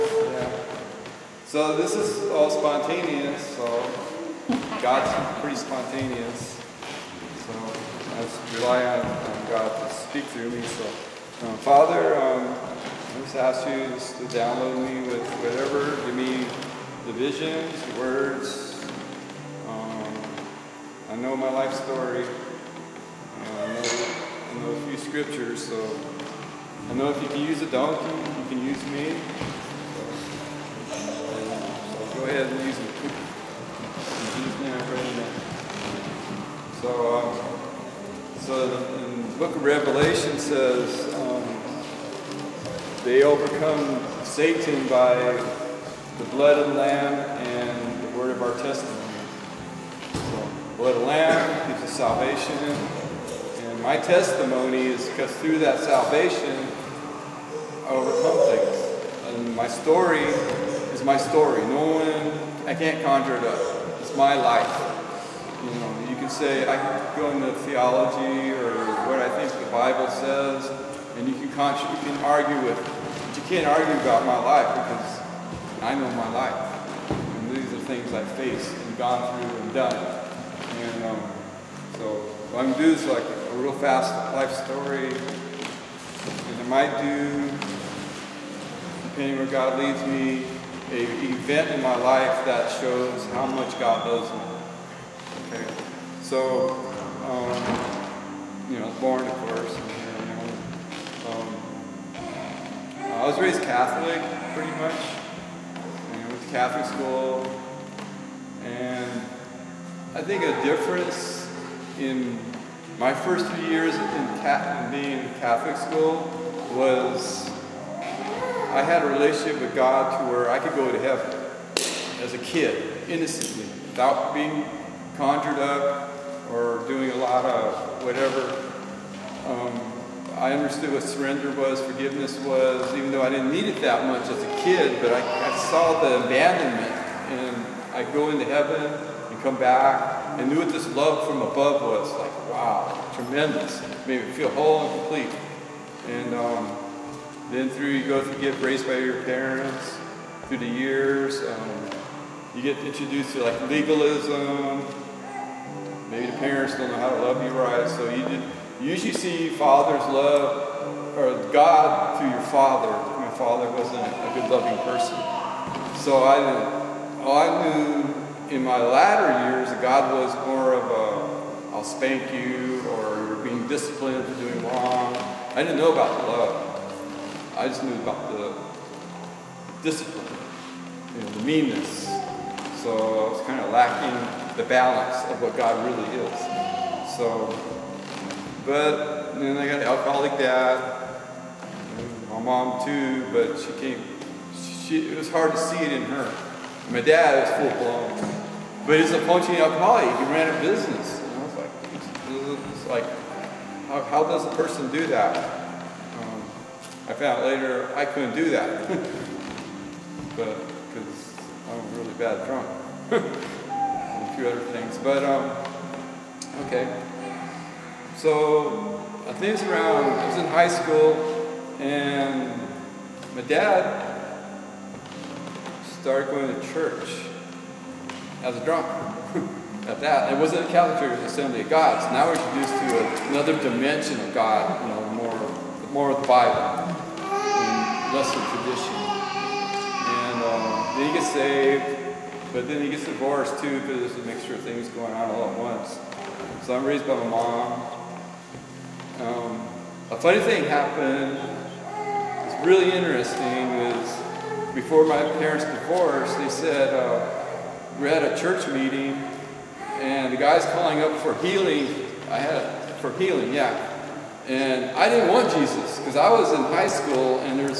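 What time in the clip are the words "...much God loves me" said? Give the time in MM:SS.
01:33.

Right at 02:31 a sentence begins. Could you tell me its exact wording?
Um, you get introduced to like legalism.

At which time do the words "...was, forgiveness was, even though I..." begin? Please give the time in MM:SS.
02:11.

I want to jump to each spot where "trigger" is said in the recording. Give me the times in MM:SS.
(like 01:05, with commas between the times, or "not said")
not said.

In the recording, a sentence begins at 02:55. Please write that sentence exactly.
I didn't know about the love.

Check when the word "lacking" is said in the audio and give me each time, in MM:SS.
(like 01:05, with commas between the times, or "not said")
03:03.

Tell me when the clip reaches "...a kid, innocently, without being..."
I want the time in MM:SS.
02:02.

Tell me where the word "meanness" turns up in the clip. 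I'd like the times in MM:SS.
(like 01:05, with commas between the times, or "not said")
03:01.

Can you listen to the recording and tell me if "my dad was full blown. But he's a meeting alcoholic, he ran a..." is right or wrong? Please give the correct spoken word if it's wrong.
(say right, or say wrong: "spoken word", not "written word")
wrong: "functioning", not "meeting".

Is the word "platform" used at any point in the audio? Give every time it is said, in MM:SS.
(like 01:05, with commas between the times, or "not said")
not said.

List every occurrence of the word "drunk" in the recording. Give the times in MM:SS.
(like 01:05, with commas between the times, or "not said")
03:32, 03:48.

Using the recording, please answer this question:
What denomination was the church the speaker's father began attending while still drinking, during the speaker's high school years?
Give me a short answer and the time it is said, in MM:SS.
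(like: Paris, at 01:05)
Assembly of God, at 03:51.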